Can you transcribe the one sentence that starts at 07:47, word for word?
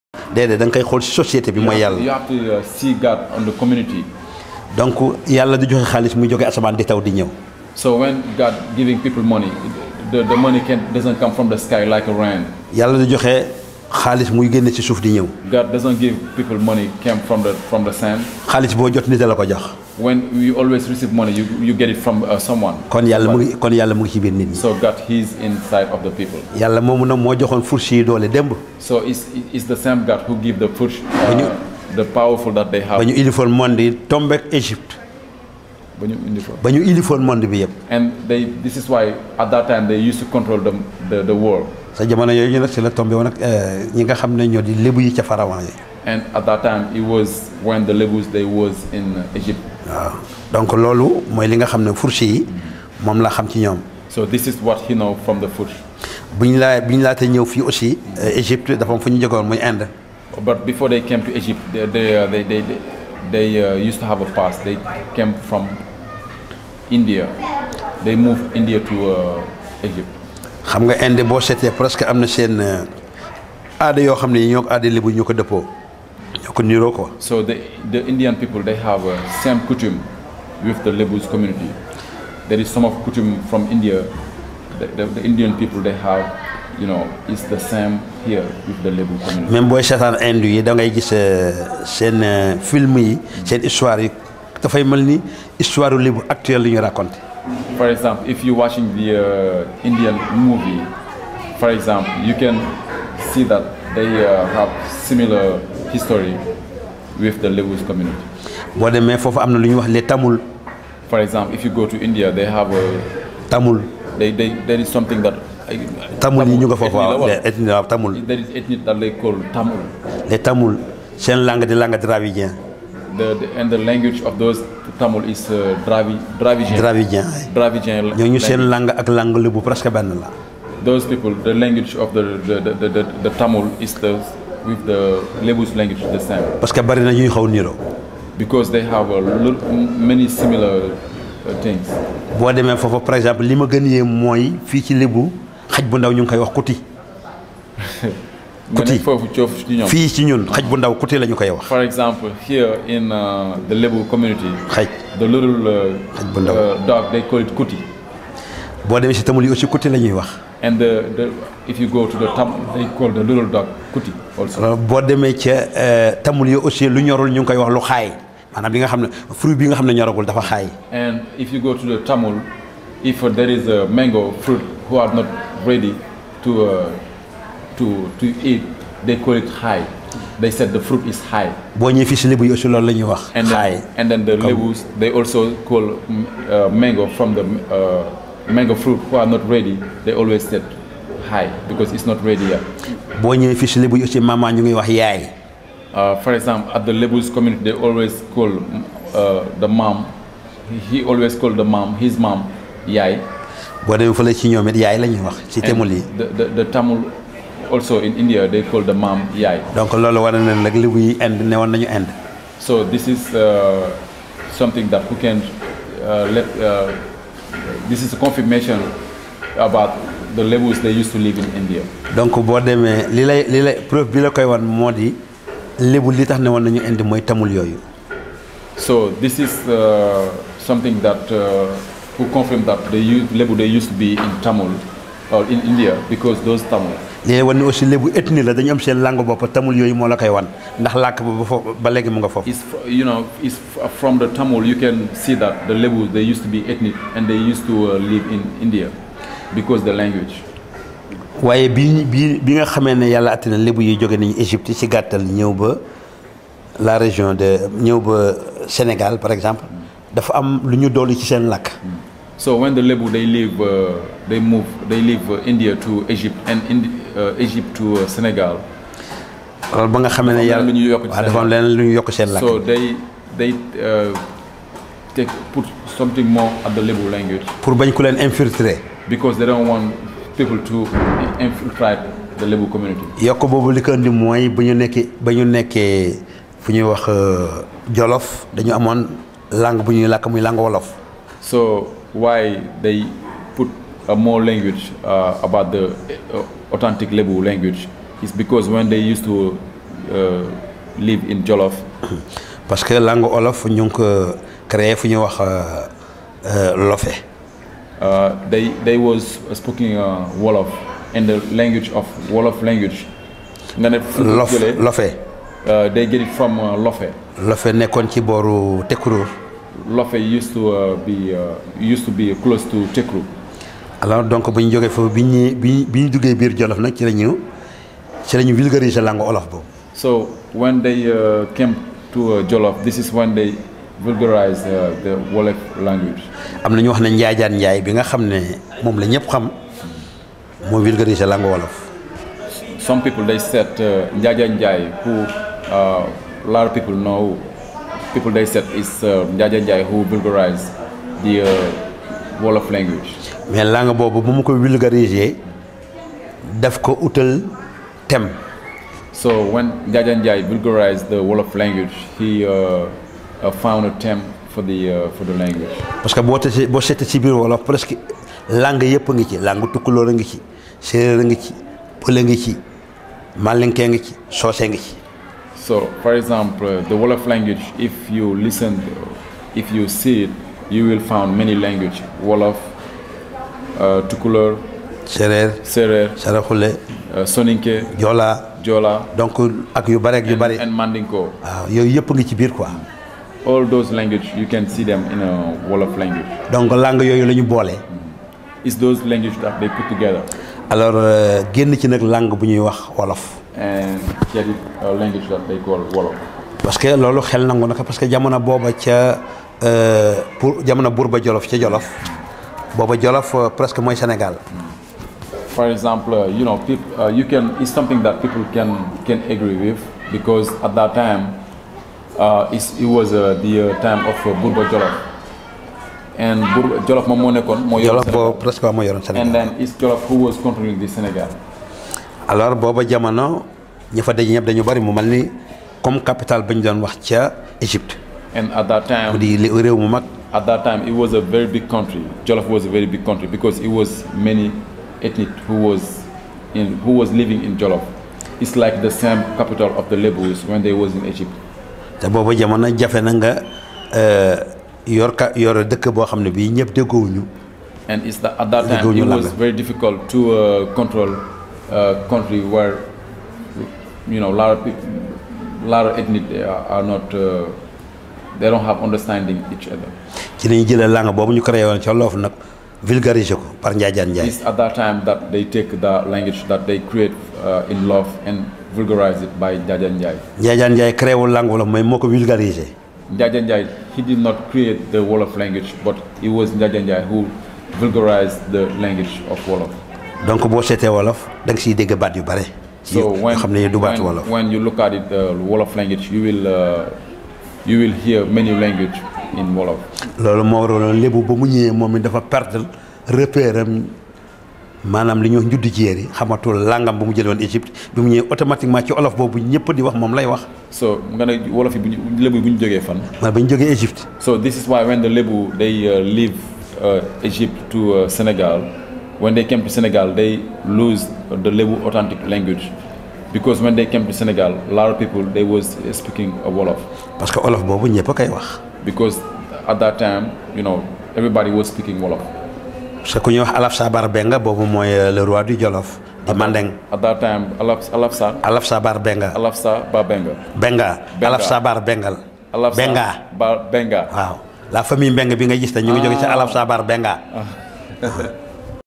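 Uh, they don't have understanding each other.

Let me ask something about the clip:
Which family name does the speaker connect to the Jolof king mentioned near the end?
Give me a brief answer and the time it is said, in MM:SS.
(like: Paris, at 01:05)
Mbengue, at 09:04.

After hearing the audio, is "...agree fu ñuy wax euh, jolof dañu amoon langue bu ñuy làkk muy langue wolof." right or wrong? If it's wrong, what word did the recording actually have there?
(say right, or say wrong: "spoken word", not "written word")
wrong: "nekkee", not "agree".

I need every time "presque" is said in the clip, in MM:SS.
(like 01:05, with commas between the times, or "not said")
01:11, 06:07, 06:53, 07:08.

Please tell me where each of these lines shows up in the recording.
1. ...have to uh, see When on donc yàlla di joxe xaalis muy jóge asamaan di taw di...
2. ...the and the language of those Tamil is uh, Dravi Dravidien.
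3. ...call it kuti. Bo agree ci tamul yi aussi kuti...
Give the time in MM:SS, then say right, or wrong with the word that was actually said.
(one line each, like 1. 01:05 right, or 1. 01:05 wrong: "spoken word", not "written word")
1. 00:02 wrong: "God", not "When"
2. 02:03 right
3. 02:37 wrong: "demee", not "agree".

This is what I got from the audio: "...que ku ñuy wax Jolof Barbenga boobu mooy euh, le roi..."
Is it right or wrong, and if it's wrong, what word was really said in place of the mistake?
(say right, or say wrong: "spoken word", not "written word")
wrong: "Alafsa", not "Jolof".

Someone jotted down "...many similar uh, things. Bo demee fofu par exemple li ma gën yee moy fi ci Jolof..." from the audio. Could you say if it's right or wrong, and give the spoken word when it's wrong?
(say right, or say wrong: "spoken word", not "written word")
wrong: "Lebu", not "Jolof".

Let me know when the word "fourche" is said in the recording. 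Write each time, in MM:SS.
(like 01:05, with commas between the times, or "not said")
00:30, 00:51.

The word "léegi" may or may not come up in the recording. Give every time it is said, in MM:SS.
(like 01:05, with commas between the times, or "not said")
03:57, 04:01.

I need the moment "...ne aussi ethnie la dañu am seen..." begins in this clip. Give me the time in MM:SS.
03:57.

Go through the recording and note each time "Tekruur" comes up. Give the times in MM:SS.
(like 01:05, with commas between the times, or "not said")
05:18, 05:22.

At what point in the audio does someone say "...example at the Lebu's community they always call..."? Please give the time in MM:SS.
03:16.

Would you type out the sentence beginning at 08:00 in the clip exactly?
Njaajaan Njaay créé wul langue Wolof moo ko vulgariser.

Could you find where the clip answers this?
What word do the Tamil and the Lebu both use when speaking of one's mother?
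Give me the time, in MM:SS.
03:24.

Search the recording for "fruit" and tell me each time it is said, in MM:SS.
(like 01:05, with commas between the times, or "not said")
02:49, 02:54, 03:00, 03:08.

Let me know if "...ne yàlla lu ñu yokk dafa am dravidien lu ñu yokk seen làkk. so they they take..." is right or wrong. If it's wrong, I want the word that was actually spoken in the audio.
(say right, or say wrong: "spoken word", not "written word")
wrong: "leneen", not "dravidien".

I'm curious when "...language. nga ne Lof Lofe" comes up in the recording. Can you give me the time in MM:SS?
05:12.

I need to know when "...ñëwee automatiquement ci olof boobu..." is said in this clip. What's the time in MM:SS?
08:28.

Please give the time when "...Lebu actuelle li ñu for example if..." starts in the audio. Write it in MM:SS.
01:34.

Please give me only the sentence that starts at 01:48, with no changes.
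boo demee foofu am na lu Tamil.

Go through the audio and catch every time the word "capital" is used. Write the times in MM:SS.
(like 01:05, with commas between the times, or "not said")
07:15, 07:29.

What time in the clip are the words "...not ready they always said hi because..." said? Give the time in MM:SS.
03:09.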